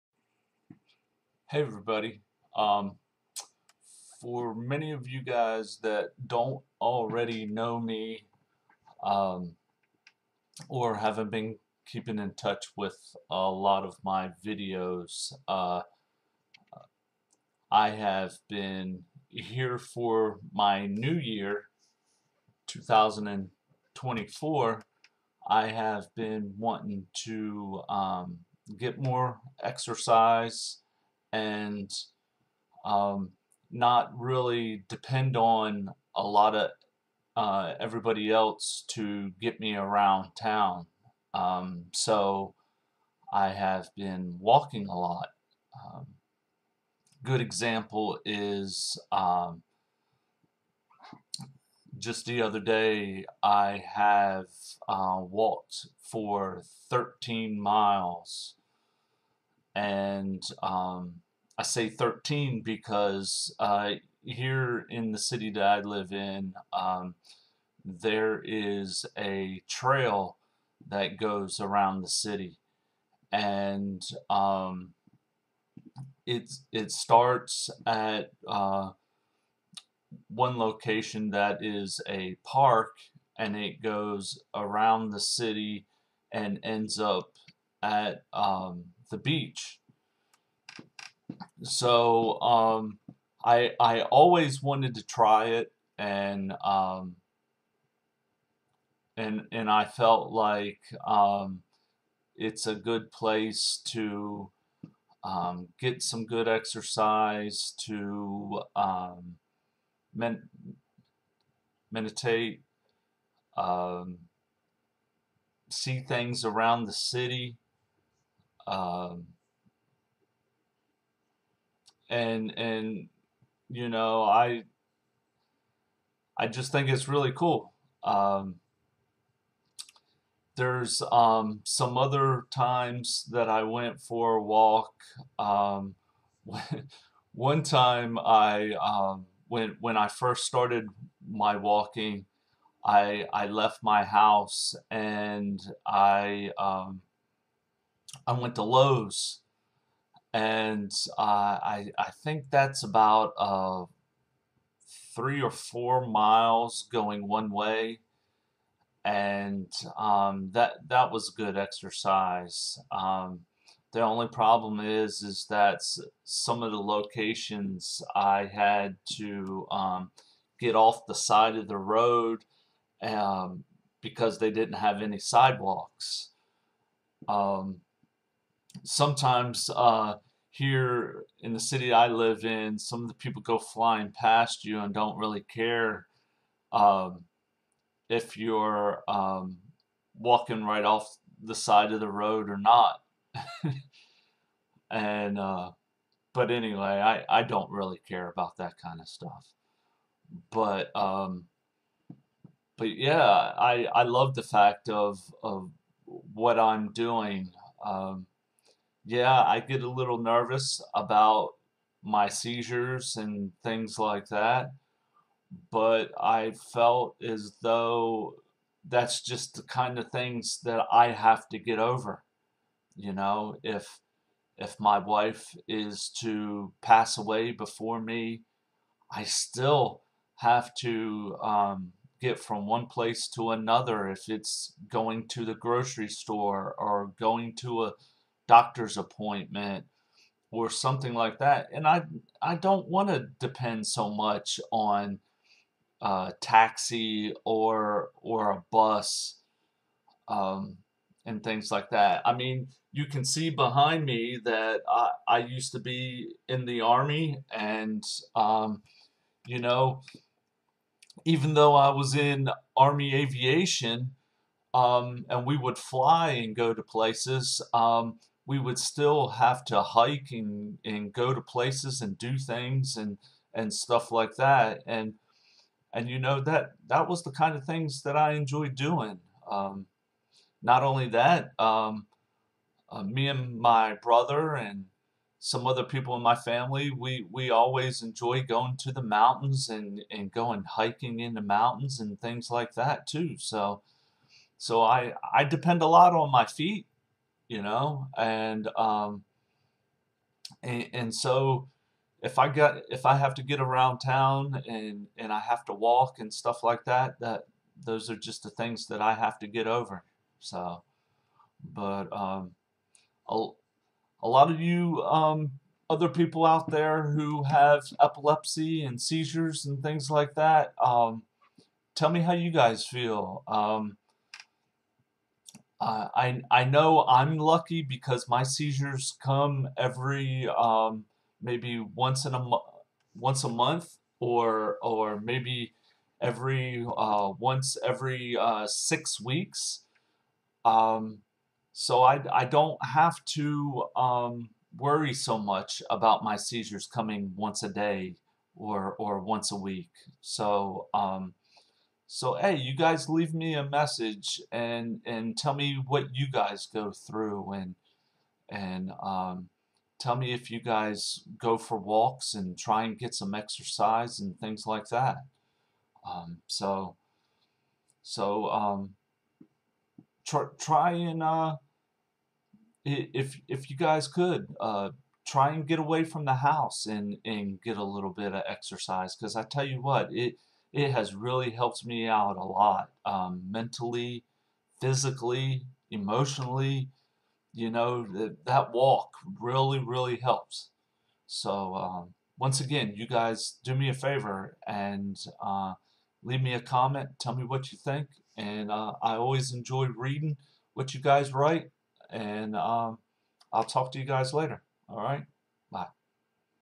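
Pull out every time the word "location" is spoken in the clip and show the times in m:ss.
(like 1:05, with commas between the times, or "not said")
1:20, 2:46.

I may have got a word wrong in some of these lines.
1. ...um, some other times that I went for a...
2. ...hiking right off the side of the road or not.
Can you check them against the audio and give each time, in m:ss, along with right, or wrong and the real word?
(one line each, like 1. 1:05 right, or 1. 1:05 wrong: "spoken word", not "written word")
1. 2:11 right
2. 3:10 wrong: "walking", not "hiking".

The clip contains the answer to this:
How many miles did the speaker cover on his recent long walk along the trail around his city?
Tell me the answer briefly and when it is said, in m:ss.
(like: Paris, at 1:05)
13, at 0:56.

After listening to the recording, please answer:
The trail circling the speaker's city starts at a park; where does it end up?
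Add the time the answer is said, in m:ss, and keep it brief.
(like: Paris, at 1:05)
the beach, at 1:29.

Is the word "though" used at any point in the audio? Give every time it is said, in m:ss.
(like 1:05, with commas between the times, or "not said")
3:37, 4:21.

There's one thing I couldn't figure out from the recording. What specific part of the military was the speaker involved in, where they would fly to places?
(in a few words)
army aviation.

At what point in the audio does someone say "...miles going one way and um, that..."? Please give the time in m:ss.
2:36.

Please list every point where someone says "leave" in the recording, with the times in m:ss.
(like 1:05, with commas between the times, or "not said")
5:53, 6:36.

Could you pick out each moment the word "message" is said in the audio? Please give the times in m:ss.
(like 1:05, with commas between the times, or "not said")
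5:53.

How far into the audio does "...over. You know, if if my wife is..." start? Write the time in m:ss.
3:41.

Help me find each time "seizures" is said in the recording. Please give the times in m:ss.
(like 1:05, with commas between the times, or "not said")
3:32, 5:19, 5:28, 5:46.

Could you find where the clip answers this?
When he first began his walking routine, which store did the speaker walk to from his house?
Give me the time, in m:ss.
2:28.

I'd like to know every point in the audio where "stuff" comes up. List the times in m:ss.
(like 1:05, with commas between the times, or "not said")
3:19, 4:33, 5:06.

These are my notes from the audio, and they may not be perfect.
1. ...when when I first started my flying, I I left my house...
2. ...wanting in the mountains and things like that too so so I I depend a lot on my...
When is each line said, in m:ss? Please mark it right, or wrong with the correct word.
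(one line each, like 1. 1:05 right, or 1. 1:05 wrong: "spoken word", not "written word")
1. 2:19 wrong: "walking", not "flying"
2. 4:50 wrong: "hiking", not "wanting".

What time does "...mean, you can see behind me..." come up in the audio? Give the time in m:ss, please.
4:12.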